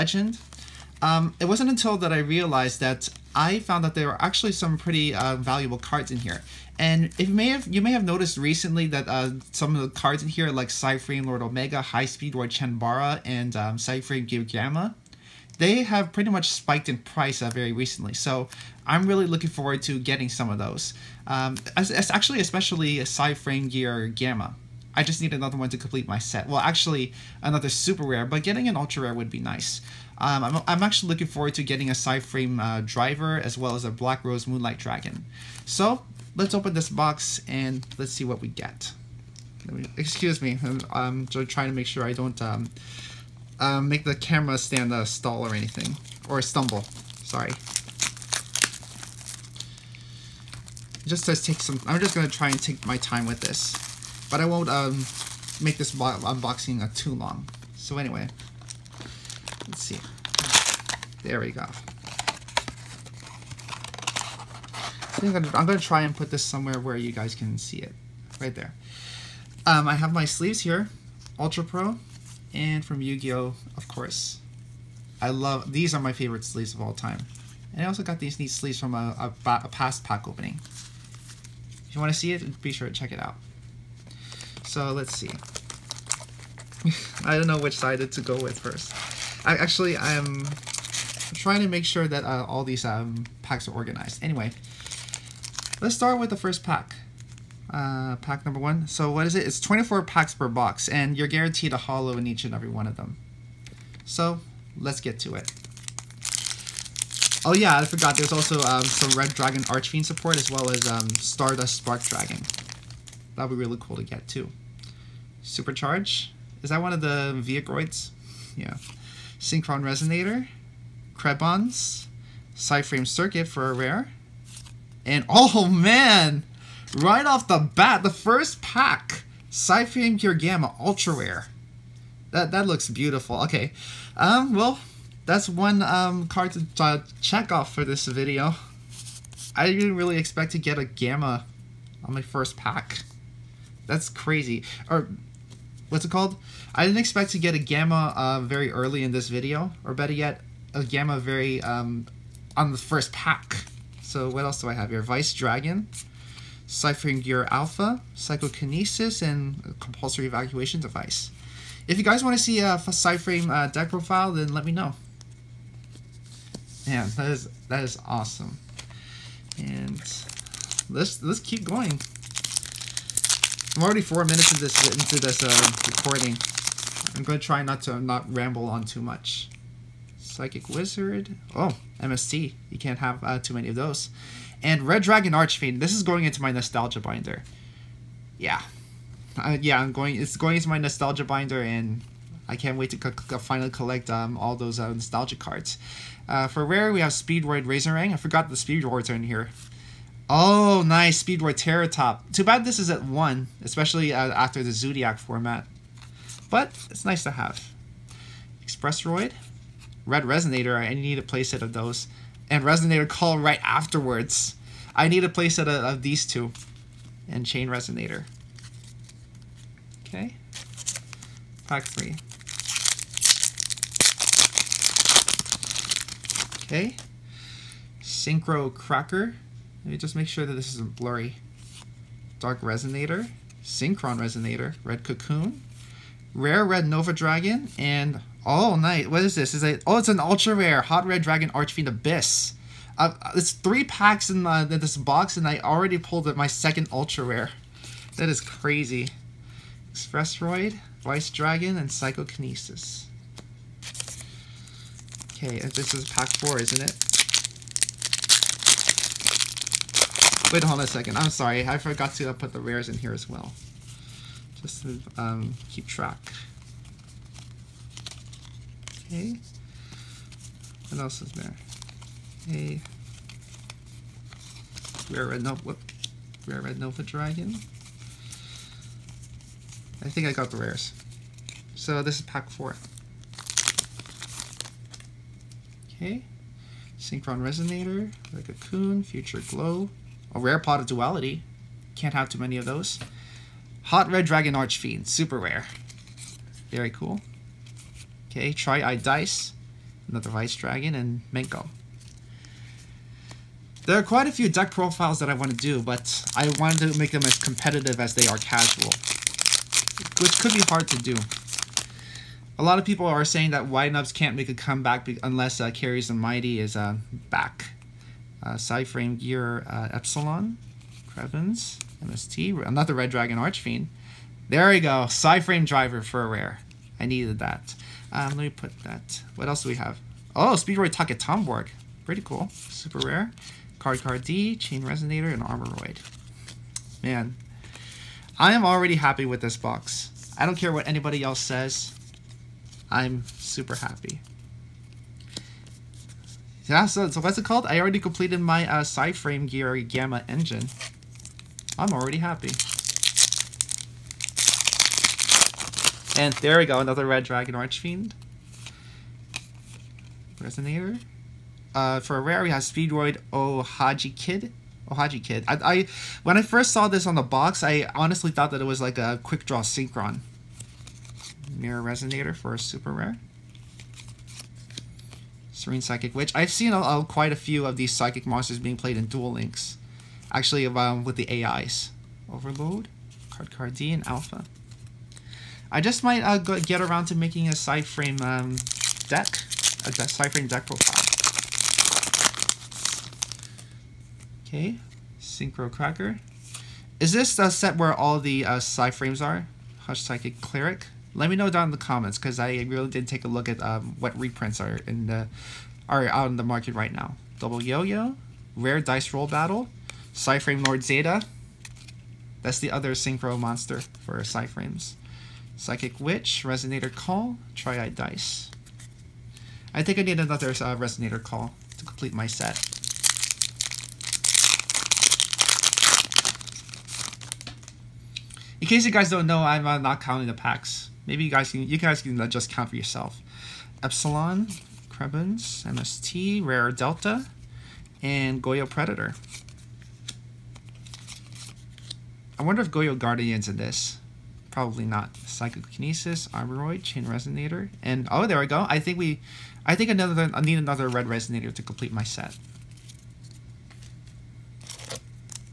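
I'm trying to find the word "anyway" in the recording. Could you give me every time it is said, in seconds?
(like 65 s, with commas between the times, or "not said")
57 s, 94 s.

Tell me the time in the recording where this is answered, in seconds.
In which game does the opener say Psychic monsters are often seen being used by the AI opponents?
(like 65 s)
379 s.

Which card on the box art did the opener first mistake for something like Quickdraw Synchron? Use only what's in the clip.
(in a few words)
Speedroid Ohajikid.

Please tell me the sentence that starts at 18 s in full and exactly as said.
So I'm really looking forward to getting some of those.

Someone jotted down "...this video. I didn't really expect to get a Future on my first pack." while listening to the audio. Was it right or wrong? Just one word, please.
wrong.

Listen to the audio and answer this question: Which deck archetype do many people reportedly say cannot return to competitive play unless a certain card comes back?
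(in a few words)
Wind-Ups.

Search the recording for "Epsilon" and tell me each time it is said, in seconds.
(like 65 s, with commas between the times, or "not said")
319 s, 433 s.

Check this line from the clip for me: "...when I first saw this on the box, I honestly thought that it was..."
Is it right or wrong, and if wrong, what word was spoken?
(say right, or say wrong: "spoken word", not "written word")
right.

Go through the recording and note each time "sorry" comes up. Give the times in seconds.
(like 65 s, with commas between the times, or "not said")
47 s, 261 s.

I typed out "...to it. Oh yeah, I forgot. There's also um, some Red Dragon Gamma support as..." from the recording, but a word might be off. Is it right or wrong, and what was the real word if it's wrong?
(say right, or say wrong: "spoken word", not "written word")
wrong: "Archfiend", not "Gamma".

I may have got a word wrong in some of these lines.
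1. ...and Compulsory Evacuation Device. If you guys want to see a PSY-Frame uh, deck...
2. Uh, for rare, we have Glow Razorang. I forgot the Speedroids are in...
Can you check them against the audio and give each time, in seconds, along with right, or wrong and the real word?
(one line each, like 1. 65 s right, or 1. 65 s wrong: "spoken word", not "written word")
1. 159 s right
2. 196 s wrong: "Speedroid", not "Glow".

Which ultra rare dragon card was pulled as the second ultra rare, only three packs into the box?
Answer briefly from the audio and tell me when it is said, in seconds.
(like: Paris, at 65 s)
Hot Red Dragon Archfiend Abyss, at 240 s.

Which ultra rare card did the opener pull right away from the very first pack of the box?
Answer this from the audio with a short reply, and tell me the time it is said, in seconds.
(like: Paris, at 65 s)
PSY-Frame Gamma, at 129 s.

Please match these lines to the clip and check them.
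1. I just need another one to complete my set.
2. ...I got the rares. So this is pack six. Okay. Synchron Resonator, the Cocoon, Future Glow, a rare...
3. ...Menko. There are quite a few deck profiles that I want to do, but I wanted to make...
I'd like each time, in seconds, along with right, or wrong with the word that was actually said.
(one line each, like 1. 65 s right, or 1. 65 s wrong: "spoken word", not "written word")
1. 24 s right
2. 280 s wrong: "four", not "six"
3. 301 s right.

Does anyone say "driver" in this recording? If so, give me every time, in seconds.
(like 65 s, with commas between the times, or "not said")
32 s, 325 s.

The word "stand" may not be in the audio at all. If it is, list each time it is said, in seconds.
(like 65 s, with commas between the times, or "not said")
44 s.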